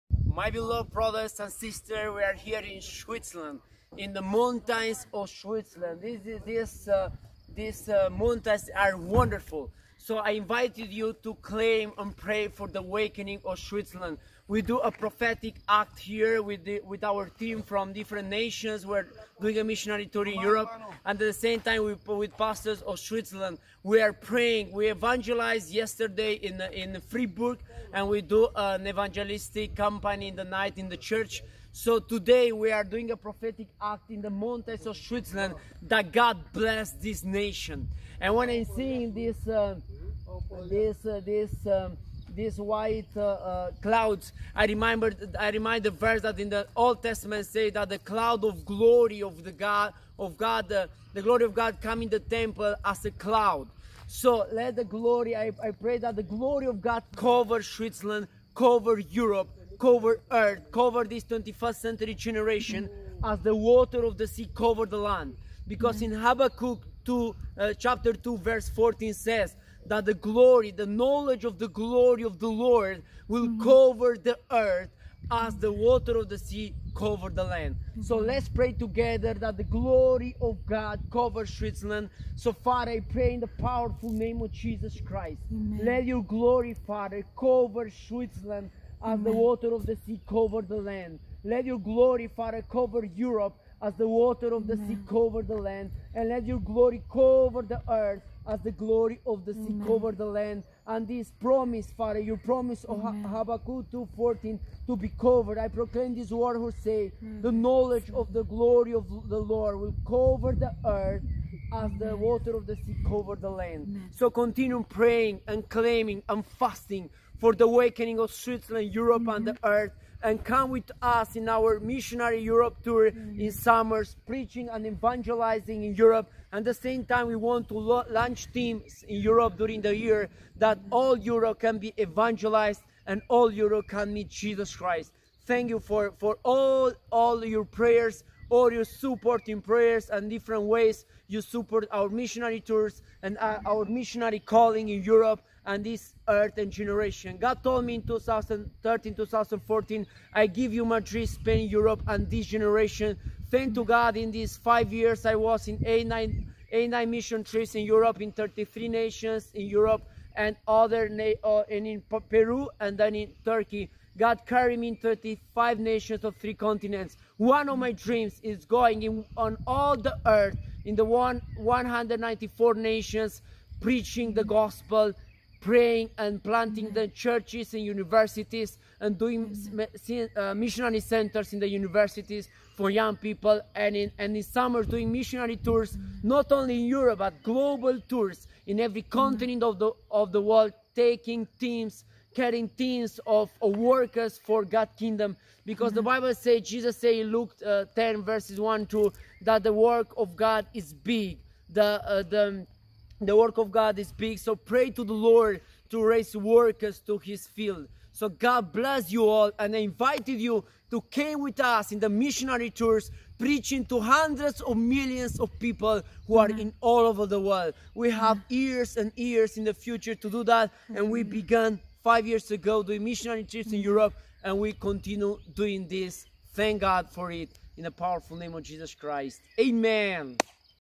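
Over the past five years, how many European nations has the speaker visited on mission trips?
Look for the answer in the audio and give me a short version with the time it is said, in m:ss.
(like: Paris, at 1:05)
33, at 2:38.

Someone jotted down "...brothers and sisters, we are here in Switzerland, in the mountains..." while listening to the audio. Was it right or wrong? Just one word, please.
right.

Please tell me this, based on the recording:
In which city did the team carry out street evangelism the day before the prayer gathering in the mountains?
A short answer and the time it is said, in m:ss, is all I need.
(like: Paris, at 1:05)
Freiburg, at 0:27.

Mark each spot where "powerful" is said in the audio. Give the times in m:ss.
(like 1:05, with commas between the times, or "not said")
1:23, 3:47.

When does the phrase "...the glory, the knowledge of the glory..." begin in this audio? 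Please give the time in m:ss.
1:10.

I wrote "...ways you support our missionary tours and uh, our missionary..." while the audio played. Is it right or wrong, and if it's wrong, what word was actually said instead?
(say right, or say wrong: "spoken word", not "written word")
right.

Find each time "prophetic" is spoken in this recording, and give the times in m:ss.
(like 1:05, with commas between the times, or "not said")
0:14, 0:33.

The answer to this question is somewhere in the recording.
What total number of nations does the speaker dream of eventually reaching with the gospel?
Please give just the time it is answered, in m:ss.
2:51.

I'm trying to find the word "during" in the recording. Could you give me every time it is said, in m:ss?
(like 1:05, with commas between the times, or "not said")
2:09.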